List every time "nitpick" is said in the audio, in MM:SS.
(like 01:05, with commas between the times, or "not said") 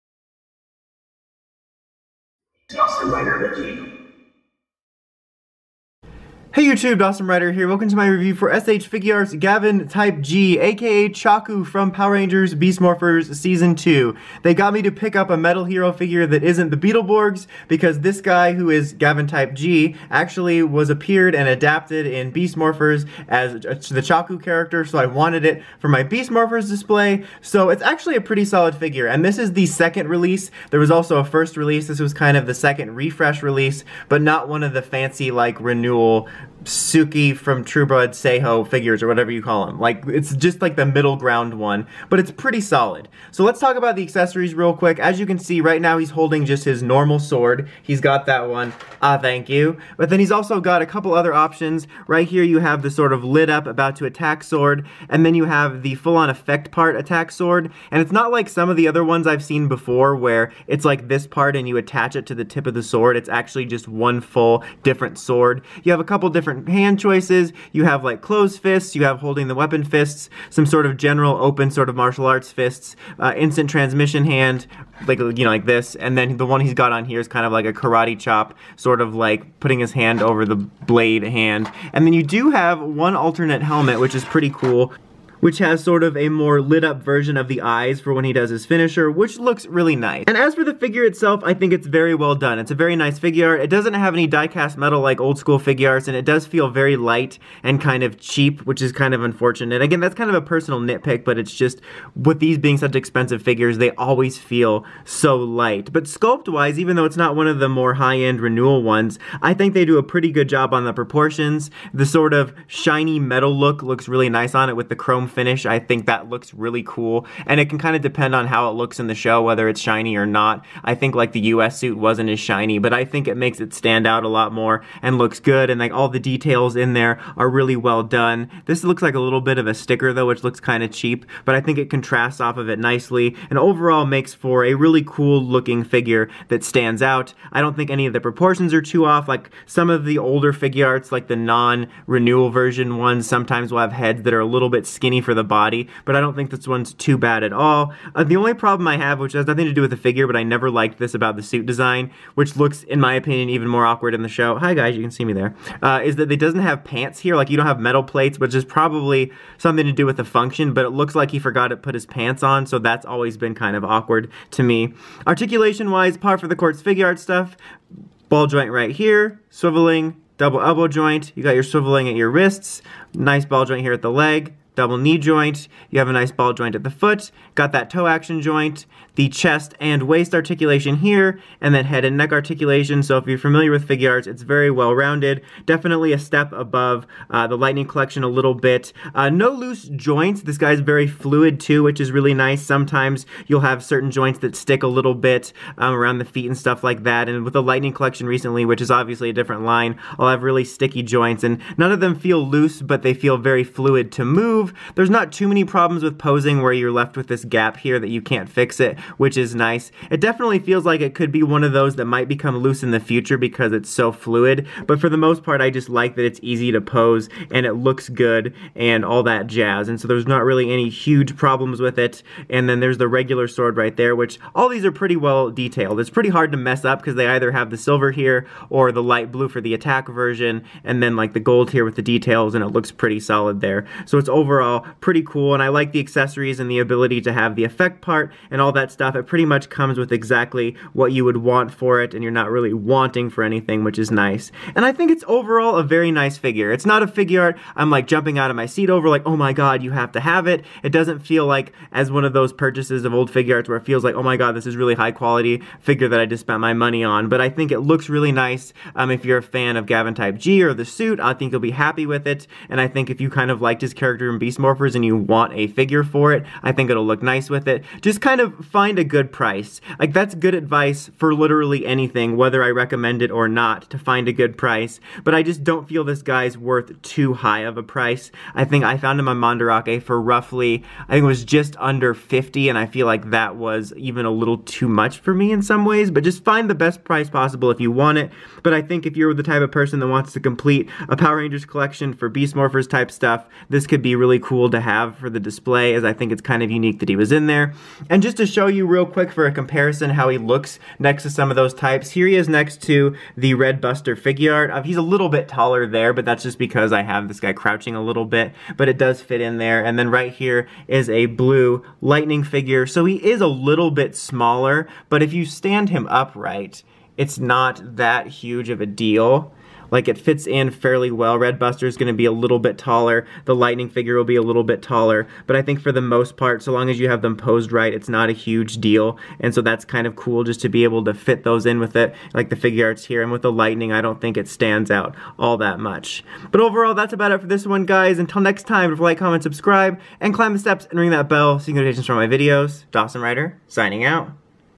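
01:40.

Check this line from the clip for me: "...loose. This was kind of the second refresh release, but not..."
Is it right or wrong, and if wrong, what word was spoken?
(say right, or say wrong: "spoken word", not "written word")
wrong: "release", not "loose".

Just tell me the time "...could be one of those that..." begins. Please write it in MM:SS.
03:31.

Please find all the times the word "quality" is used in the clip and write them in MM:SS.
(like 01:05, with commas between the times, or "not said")
04:15.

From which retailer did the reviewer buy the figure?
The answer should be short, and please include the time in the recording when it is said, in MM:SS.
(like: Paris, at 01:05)
Mandarake, at 04:39.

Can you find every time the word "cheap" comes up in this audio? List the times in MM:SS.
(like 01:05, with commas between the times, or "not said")
01:38, 02:10.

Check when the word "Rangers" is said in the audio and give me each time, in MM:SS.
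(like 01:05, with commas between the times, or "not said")
00:12, 04:51.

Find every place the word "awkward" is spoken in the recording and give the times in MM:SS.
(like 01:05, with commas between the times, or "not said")
02:33, 02:43.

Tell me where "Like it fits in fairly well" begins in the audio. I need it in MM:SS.
05:19.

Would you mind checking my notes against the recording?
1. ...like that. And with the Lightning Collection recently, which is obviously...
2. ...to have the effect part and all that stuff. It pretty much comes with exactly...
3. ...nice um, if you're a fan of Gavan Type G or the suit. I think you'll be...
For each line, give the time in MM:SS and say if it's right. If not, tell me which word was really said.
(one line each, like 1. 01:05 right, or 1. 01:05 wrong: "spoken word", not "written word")
1. 03:16 right
2. 03:57 right
3. 04:18 right.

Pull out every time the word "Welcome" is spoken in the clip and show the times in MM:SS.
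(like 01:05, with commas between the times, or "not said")
00:07.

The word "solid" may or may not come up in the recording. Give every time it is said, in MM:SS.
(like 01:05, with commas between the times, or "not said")
00:28, 00:42, 03:53.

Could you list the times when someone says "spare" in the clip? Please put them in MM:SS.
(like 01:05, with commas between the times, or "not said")
not said.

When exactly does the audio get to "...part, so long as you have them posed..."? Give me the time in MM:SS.
05:26.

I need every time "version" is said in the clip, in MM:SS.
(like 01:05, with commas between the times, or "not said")
01:27, 02:22, 03:50.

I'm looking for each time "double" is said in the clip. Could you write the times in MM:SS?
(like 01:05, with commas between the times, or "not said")
02:50, 02:54.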